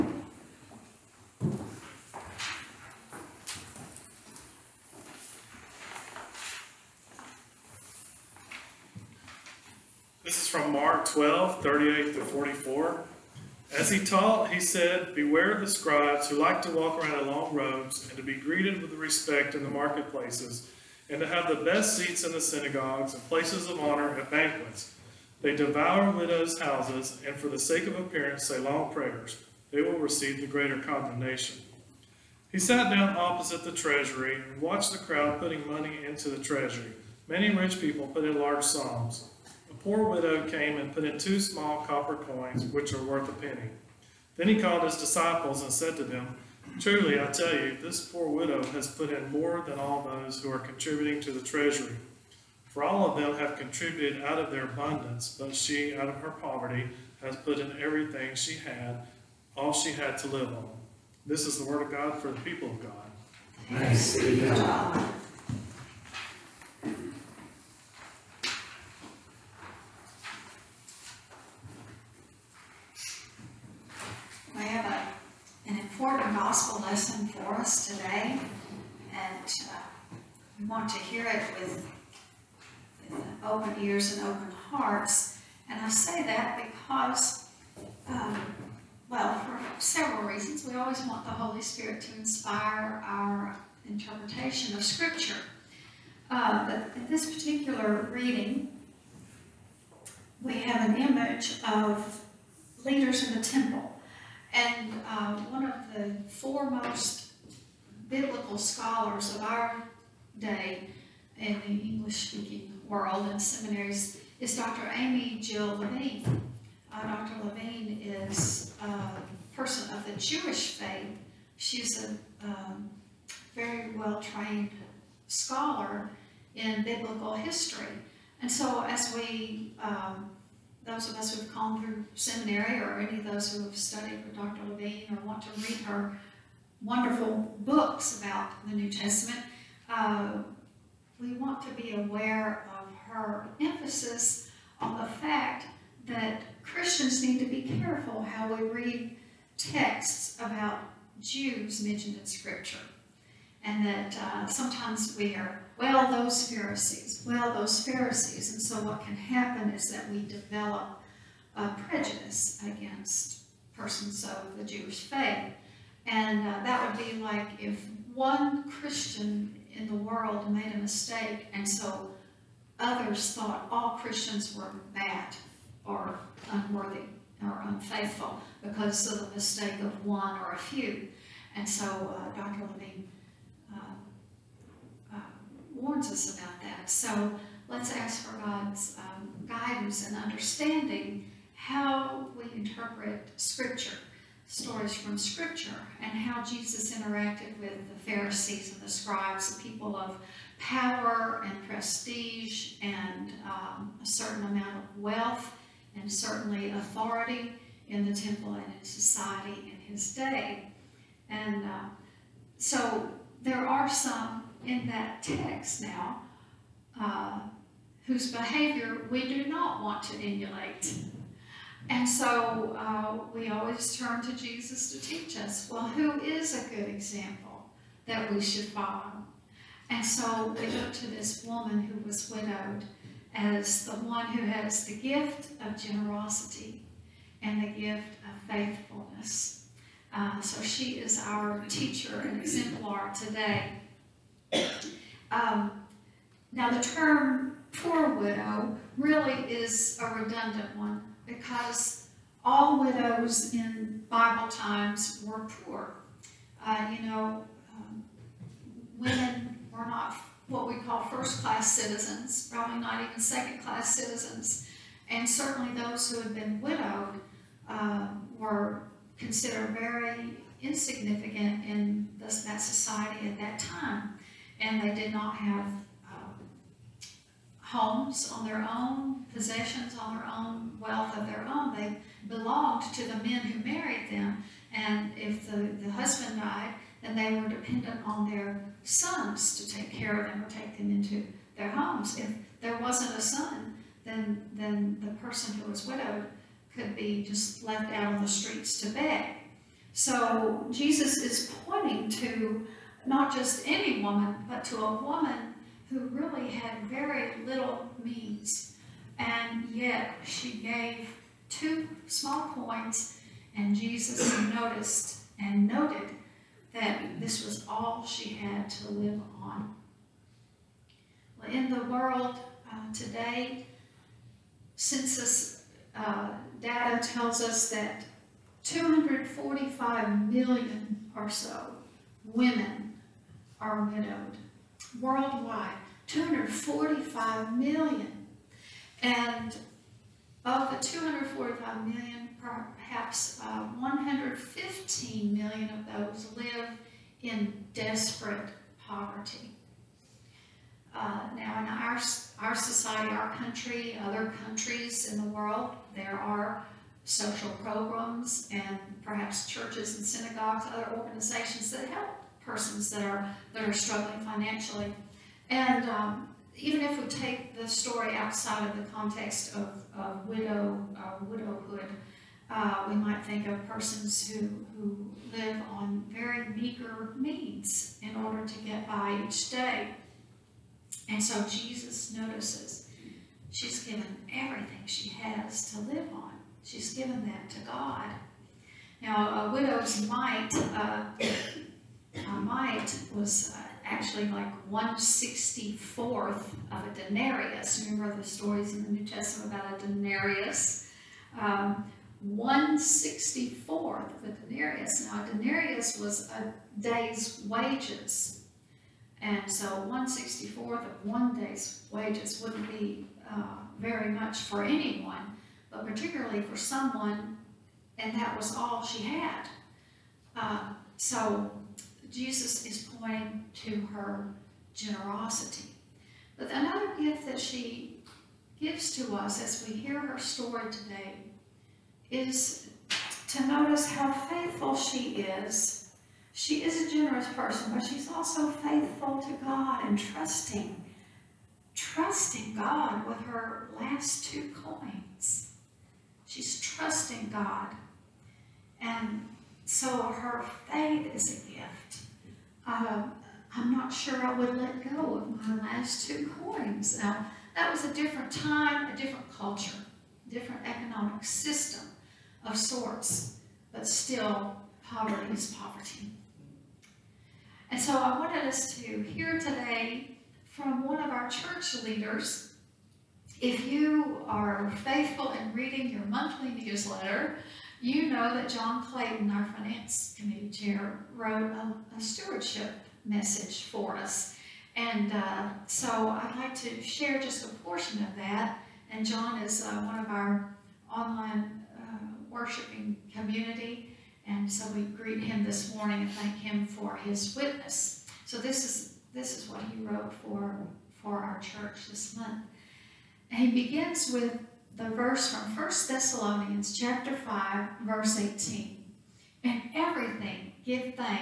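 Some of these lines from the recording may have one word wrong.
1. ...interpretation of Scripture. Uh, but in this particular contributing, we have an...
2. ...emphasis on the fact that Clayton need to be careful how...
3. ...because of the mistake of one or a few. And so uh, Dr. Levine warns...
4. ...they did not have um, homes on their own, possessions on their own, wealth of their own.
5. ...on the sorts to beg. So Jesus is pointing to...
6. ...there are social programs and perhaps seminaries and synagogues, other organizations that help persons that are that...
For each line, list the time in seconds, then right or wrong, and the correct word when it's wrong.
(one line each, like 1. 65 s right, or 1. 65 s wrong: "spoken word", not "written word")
1. 93 s wrong: "reading", not "contributing"
2. 143 s wrong: "Christians", not "Clayton"
3. 178 s right
4. 274 s right
5. 298 s wrong: "streets", not "sorts"
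6. 355 s wrong: "churches", not "seminaries".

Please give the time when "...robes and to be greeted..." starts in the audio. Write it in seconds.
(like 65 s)
17 s.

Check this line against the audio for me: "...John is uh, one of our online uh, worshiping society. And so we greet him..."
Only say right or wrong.
wrong.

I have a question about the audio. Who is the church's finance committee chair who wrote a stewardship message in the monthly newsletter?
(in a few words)
John Clayton.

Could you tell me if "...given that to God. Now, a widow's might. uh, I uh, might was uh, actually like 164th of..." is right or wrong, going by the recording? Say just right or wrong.
right.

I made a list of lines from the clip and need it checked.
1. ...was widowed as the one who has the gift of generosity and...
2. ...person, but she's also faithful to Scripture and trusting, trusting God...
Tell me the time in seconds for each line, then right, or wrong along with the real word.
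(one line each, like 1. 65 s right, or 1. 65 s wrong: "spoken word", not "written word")
1. 232 s right
2. 437 s wrong: "God", not "Scripture".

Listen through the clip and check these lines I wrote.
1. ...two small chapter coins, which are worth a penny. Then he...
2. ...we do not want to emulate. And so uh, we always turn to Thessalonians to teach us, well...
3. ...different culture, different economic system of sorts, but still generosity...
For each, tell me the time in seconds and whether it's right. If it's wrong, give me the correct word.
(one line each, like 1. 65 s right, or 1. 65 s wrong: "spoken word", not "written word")
1. 41 s wrong: "copper", not "chapter"
2. 219 s wrong: "Jesus", not "Thessalonians"
3. 458 s wrong: "poverty", not "generosity".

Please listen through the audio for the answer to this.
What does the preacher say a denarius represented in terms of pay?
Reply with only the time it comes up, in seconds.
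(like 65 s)
406 s.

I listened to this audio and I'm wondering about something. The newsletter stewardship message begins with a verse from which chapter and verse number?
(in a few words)
Chapter 5, verse 18.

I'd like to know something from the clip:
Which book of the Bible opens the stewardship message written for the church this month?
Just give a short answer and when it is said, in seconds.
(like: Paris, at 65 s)
1 Thessalonians, at 505 s.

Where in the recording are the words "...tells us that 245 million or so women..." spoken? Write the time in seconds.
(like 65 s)
327 s.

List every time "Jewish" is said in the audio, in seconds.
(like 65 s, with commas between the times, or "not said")
120 s, 164 s.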